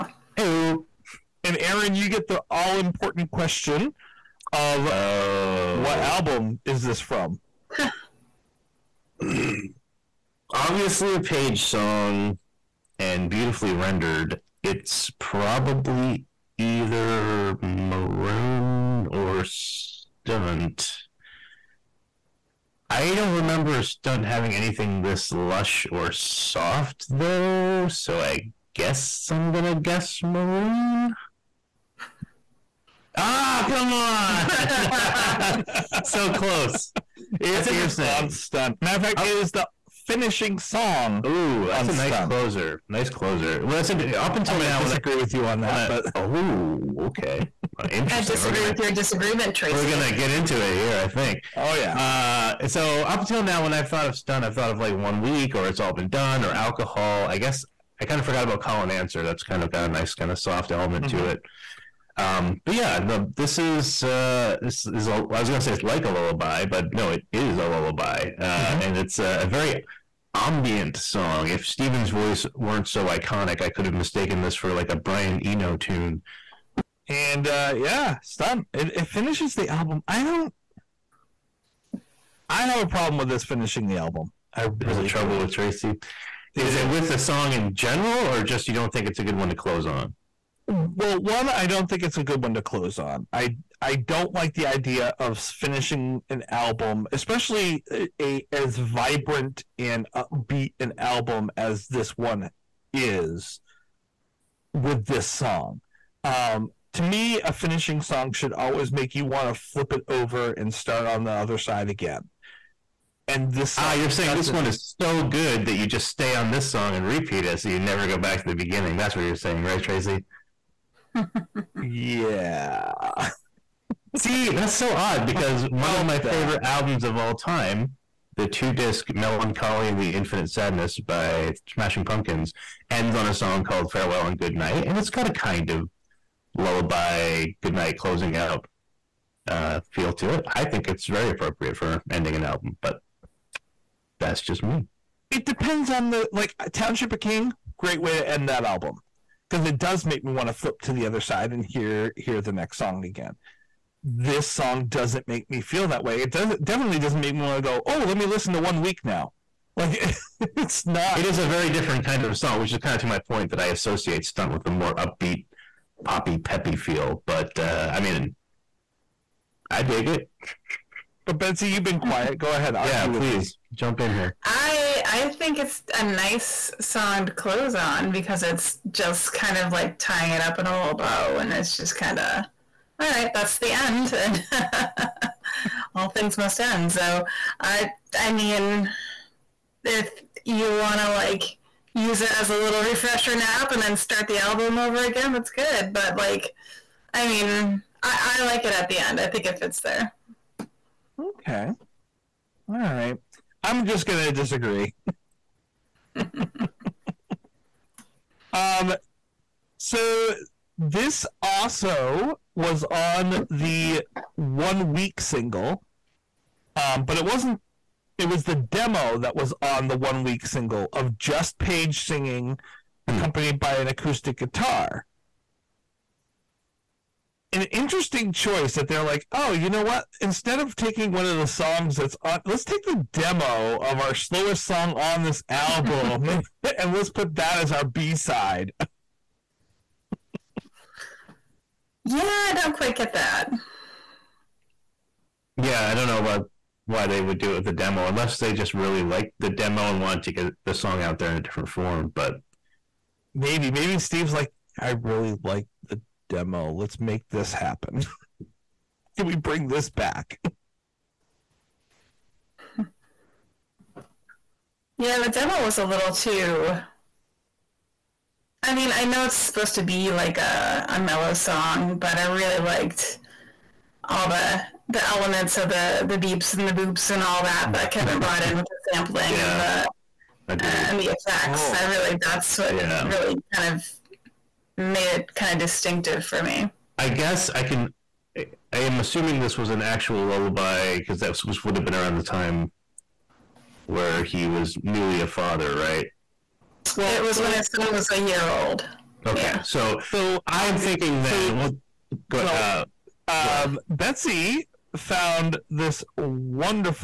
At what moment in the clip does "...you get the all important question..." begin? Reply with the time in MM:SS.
00:01.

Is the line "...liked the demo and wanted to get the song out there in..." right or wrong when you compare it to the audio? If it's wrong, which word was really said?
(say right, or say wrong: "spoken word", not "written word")
right.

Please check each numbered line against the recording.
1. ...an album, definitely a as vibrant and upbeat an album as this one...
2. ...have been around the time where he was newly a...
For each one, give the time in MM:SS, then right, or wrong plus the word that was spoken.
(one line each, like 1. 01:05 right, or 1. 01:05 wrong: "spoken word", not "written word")
1. 01:36 wrong: "especially", not "definitely"
2. 04:51 right.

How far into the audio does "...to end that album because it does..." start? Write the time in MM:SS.
02:28.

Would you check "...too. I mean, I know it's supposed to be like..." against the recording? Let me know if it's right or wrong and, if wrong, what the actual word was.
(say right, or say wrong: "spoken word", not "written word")
right.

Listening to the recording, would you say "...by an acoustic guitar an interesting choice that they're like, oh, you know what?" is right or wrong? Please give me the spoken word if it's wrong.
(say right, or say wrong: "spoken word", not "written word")
right.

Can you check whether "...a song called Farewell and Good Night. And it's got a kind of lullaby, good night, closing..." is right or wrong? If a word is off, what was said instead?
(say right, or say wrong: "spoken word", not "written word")
right.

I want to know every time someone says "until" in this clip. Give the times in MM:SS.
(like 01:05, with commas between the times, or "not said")
00:44, 00:53.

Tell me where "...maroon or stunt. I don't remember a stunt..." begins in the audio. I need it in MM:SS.
00:17.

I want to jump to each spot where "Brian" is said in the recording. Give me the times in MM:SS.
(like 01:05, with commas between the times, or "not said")
01:14.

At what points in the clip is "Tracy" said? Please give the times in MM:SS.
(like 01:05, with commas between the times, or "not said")
00:49, 01:25, 01:59.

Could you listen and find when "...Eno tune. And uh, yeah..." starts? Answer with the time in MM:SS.
01:15.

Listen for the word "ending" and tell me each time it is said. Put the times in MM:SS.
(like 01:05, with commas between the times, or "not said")
02:22.